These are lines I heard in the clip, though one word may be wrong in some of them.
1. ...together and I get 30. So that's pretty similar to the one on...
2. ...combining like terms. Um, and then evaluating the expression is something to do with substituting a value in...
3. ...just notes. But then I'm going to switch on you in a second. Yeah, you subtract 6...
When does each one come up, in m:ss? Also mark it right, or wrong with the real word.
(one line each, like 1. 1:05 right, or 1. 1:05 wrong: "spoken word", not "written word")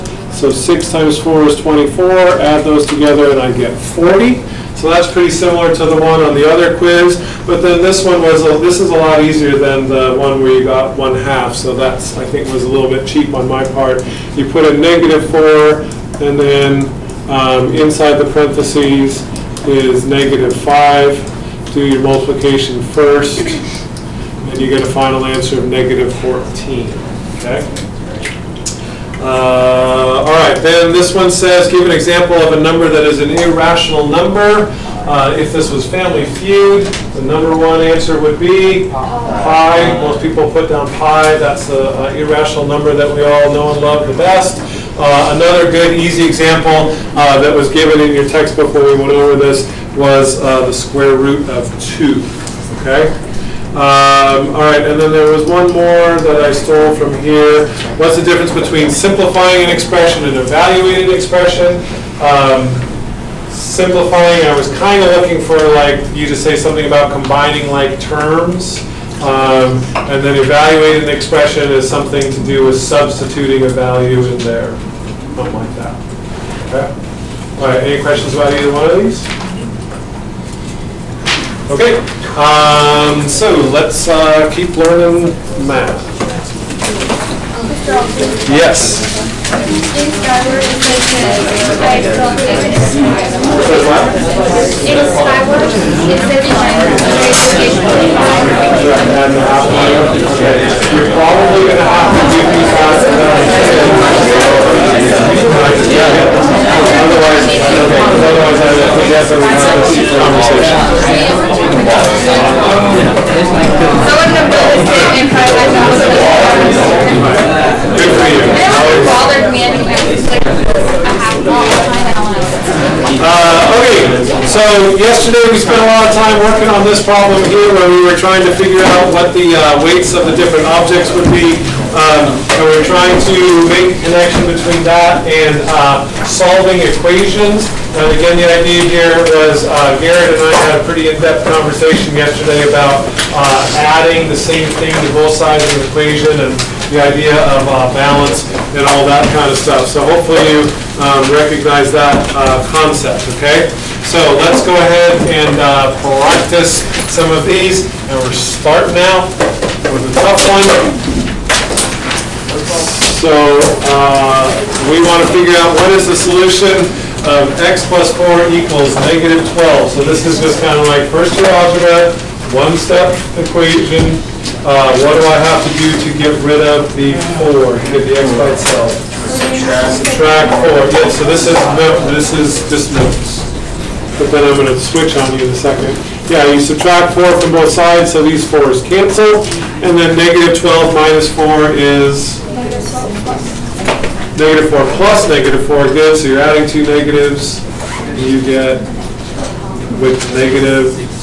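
1. 0:02 wrong: "40", not "30"
2. 1:07 right
3. 3:02 wrong: "4", not "6".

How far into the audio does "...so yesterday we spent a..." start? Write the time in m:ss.
2:04.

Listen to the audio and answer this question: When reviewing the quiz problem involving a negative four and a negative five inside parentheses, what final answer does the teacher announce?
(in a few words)
-14.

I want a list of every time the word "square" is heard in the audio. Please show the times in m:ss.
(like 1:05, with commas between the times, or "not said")
0:50.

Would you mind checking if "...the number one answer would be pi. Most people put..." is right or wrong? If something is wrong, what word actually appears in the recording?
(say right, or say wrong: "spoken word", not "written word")
right.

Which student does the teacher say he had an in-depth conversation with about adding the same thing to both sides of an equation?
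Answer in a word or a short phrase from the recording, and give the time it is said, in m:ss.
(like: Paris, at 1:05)
Garrett, at 2:20.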